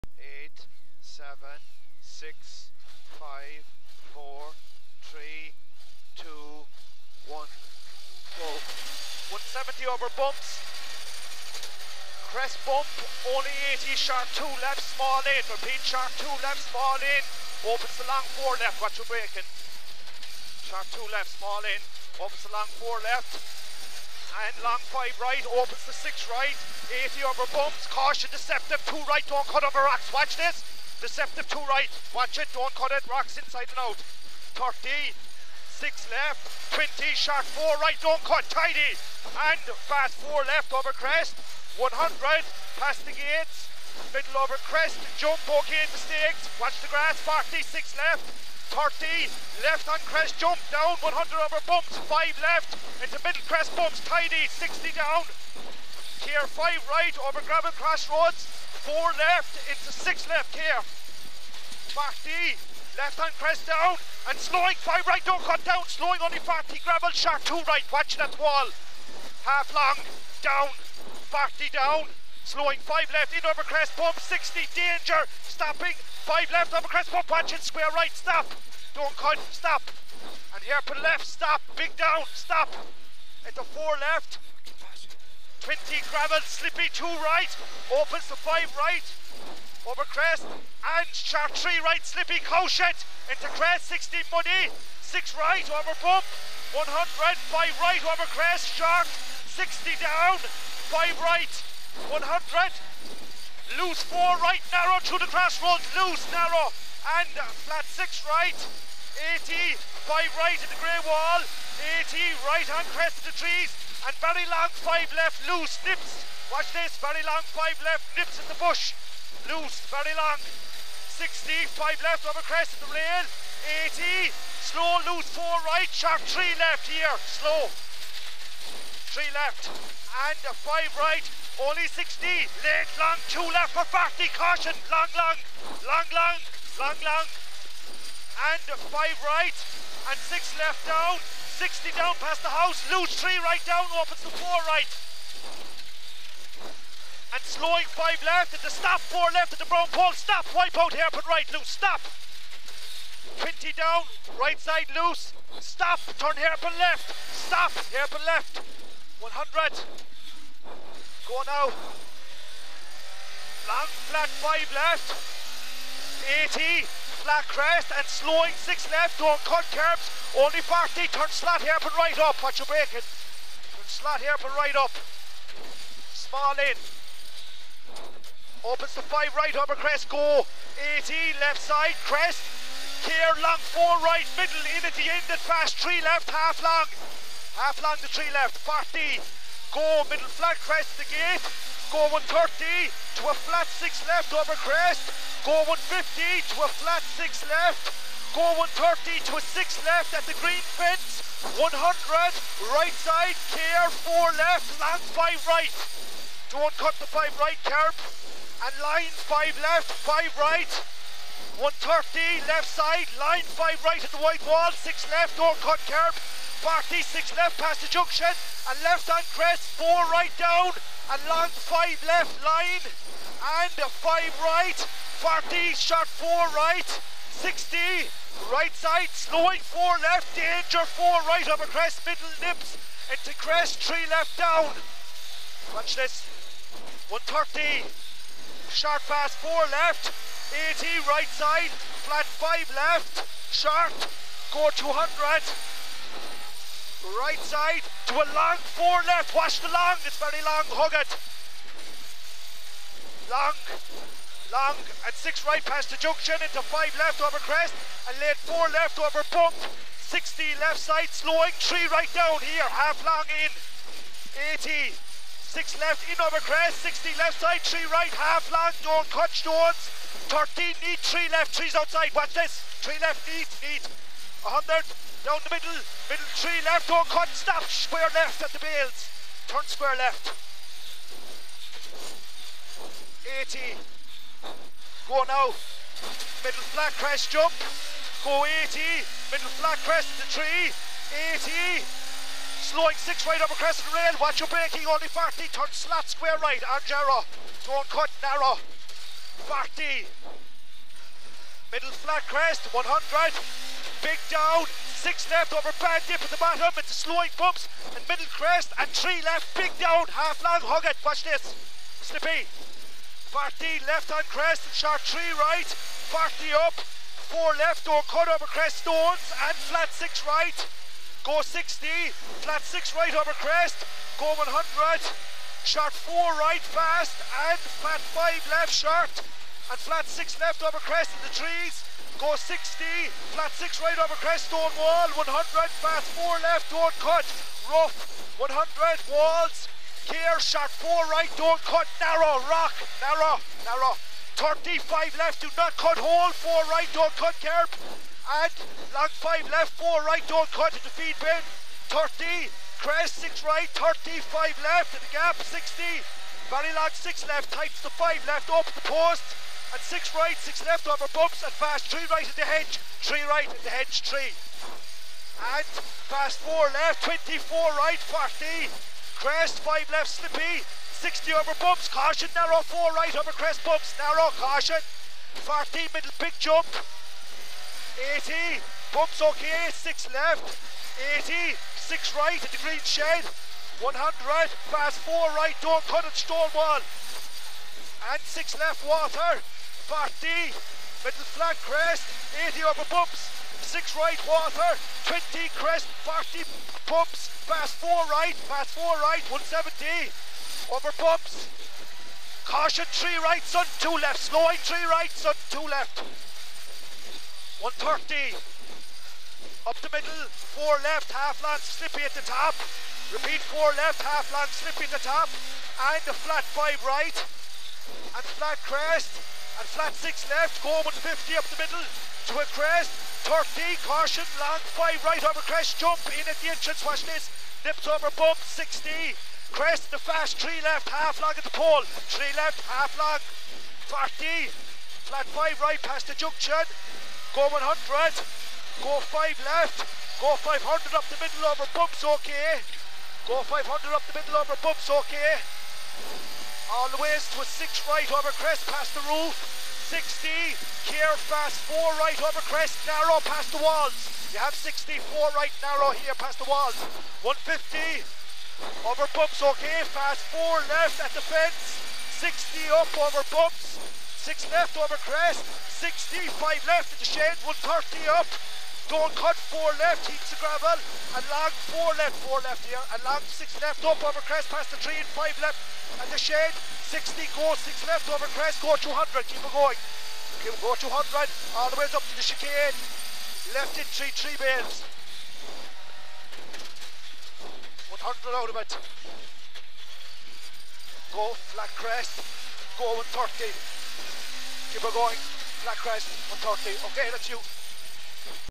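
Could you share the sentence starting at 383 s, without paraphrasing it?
100, fast four right, don't cut it, wall.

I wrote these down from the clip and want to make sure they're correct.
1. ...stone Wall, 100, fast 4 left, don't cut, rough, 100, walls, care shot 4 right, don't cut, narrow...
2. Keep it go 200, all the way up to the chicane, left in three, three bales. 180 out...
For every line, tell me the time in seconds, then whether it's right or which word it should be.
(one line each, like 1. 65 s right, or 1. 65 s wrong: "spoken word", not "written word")
1. 334 s right
2. 480 s wrong: "100", not "180".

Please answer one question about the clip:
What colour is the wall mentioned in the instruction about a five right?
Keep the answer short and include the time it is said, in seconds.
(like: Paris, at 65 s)
grey, at 110 s.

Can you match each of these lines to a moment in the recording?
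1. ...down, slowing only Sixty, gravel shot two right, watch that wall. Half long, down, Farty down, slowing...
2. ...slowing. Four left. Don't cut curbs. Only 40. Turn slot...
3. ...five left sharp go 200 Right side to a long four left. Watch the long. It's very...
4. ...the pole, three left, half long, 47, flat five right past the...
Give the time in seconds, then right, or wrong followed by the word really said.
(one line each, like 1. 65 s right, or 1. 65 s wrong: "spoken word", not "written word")
1. 65 s wrong: "Farty", not "Sixty"
2. 168 s wrong: "Six", not "Four"
3. 242 s right
4. 431 s wrong: "40", not "47".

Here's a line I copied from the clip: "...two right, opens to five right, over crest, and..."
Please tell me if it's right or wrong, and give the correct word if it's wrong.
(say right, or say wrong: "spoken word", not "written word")
right.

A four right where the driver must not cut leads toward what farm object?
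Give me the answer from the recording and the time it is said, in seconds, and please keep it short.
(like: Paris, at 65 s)
feed bin, at 350 s.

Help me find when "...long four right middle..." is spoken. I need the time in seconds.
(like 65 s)
183 s.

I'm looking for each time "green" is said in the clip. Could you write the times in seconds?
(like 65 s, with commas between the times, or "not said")
200 s, 382 s.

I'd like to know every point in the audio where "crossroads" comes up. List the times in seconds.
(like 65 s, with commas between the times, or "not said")
57 s, 105 s.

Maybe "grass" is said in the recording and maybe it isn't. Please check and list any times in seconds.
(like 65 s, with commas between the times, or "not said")
46 s.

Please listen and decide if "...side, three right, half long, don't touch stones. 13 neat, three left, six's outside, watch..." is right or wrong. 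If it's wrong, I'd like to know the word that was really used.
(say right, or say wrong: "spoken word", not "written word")
wrong: "three", not "six".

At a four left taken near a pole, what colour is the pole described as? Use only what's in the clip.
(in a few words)
brown.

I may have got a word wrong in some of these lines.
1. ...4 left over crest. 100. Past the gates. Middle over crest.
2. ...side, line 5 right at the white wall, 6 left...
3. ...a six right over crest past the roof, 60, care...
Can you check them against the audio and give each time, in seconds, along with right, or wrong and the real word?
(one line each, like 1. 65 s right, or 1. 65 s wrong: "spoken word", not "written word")
1. 40 s right
2. 212 s right
3. 447 s right.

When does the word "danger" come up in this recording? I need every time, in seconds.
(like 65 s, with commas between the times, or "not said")
74 s, 230 s.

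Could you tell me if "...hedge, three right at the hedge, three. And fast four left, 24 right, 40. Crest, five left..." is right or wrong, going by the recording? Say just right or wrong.
right.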